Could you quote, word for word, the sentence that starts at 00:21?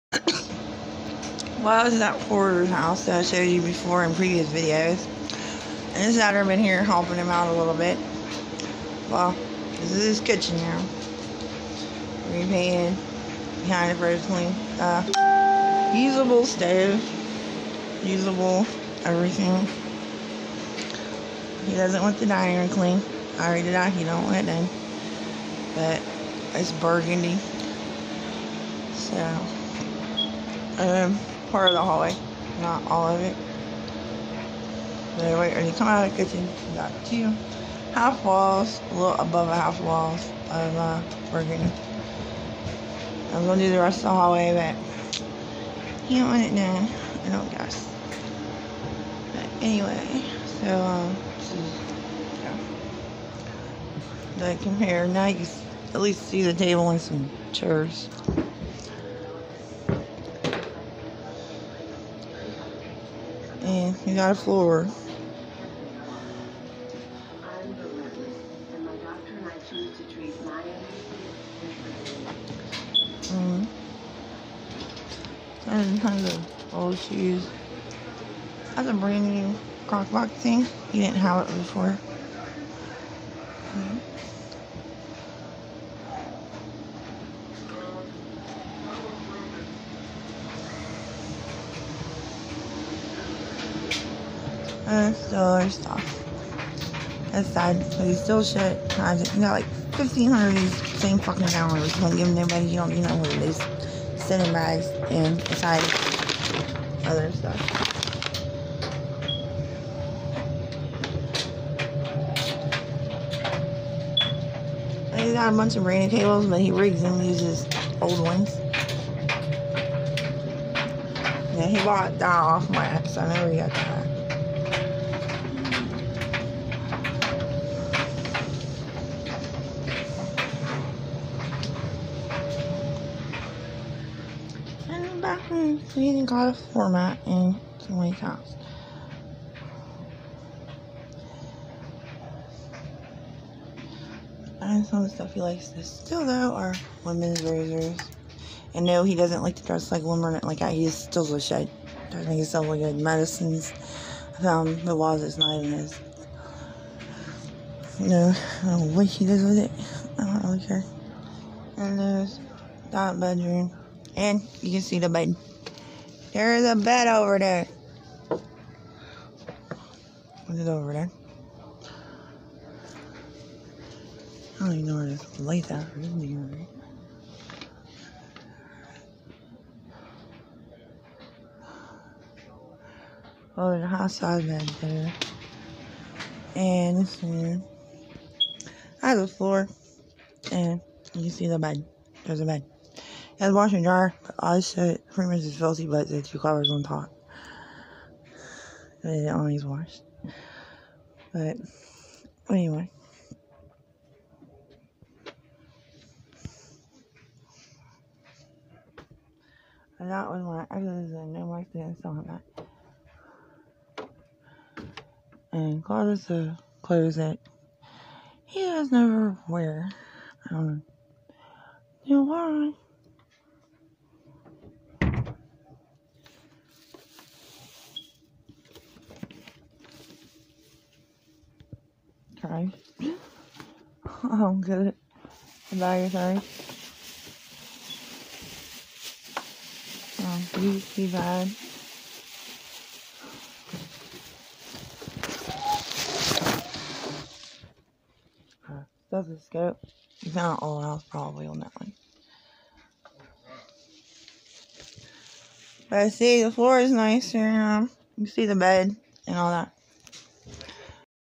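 He doesn't want the dining room clean.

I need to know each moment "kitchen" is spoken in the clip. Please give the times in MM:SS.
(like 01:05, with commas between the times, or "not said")
00:10, 00:36.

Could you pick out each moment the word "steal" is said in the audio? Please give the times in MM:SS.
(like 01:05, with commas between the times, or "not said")
02:25, 02:31.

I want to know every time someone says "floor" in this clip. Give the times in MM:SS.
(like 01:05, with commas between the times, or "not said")
01:04, 03:09, 04:16.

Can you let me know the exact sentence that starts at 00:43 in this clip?
I was gonna do the rest of the hallway, but you don't want it now.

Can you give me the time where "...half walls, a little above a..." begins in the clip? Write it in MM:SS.
00:37.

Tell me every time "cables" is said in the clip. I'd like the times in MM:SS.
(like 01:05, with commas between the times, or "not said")
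01:56.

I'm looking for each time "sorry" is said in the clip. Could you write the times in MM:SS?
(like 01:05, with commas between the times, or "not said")
03:56.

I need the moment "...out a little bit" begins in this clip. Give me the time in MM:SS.
00:07.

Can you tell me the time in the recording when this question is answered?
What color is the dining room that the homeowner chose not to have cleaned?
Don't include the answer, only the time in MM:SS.
00:26.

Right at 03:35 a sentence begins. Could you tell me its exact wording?
And clothes uh, clothes that he has never wear.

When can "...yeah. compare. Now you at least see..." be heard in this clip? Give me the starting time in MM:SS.
00:54.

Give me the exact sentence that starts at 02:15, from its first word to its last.
yeah, hmm, forgetting how to format in some way counts.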